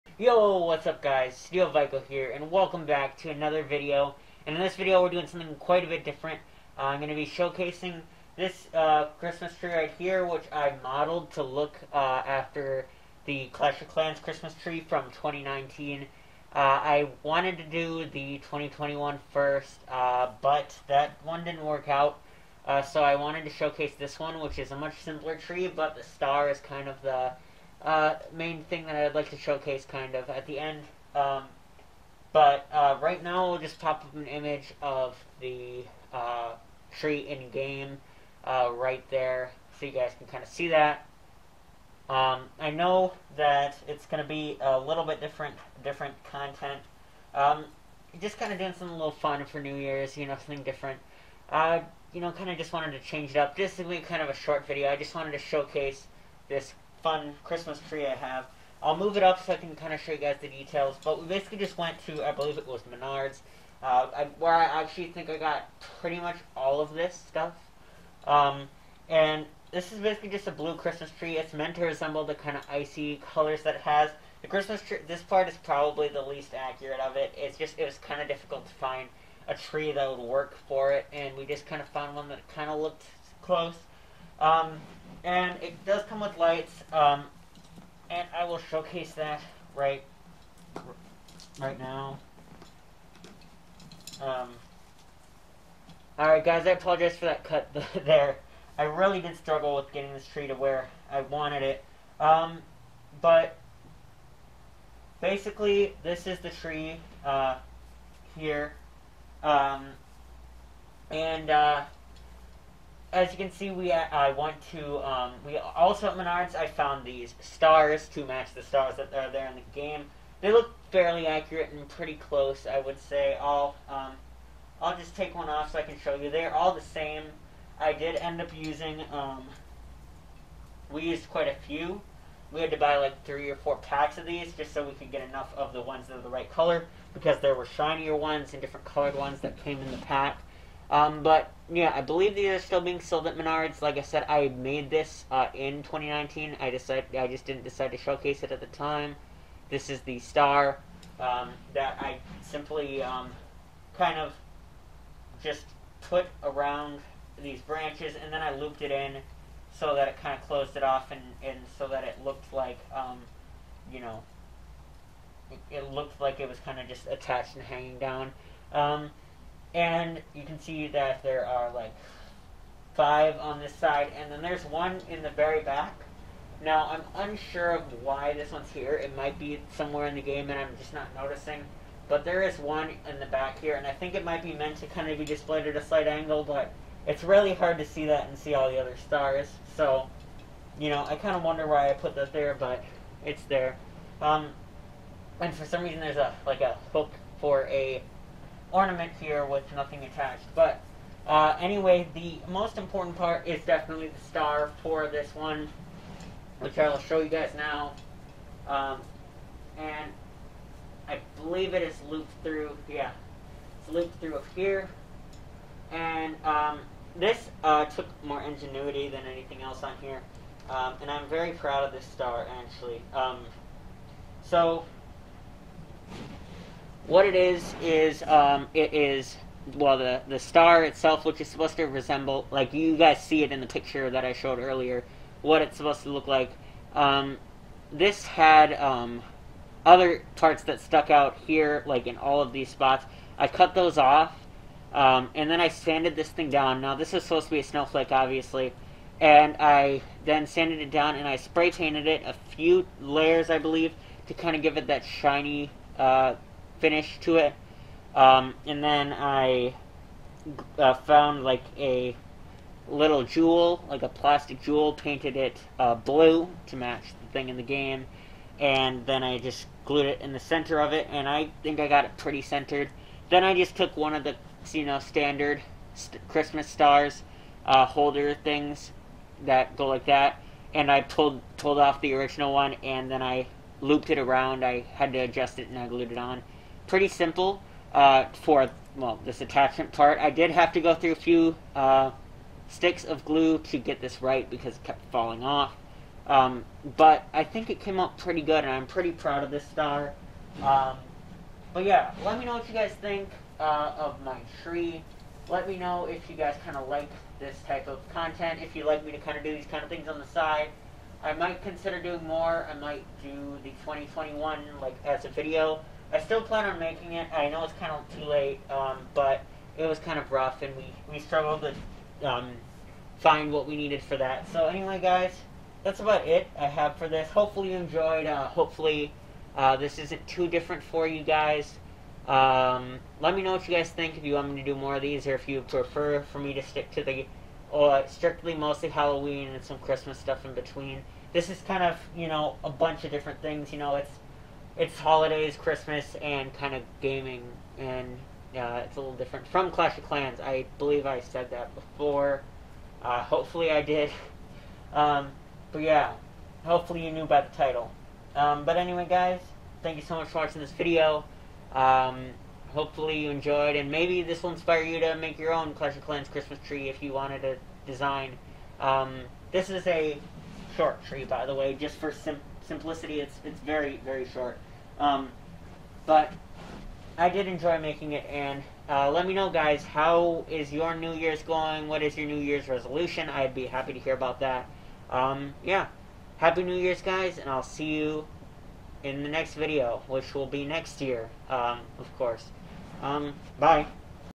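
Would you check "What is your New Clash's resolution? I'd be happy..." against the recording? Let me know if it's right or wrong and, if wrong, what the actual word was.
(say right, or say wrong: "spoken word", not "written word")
wrong: "Year", not "Clash".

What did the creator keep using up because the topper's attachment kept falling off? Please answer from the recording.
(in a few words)
sticks of glue.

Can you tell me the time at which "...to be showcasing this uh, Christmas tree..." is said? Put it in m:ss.
0:07.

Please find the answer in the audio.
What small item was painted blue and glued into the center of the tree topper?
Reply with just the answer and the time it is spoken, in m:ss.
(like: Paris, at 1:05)
plastic jewel, at 4:24.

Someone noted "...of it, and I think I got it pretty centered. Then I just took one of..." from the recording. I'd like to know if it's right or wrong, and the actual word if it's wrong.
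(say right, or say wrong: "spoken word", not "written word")
right.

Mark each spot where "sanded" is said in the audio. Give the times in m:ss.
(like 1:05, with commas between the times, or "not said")
4:05, 4:10.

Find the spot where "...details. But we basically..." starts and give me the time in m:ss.
1:00.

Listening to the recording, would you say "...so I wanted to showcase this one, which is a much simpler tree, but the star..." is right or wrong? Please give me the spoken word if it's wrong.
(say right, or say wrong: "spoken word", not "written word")
right.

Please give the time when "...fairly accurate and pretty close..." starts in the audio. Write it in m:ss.
2:00.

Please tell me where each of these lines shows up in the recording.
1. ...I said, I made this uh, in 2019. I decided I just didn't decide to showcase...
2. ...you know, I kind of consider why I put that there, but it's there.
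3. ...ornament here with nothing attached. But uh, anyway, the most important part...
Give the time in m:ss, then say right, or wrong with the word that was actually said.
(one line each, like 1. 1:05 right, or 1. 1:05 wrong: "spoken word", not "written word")
1. 2:23 right
2. 3:10 wrong: "wonder", not "consider"
3. 3:18 right.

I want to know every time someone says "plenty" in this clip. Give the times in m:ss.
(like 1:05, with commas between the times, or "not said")
not said.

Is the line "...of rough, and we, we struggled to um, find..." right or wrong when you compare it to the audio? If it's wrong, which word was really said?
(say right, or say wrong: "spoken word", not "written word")
right.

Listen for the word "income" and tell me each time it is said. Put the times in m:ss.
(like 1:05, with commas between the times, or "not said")
not said.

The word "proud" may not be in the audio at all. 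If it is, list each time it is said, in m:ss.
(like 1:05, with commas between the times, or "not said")
3:41, 4:59.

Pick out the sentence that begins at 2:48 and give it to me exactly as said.
Um, and you can see that there are like five on this side, and then there's one in the very back.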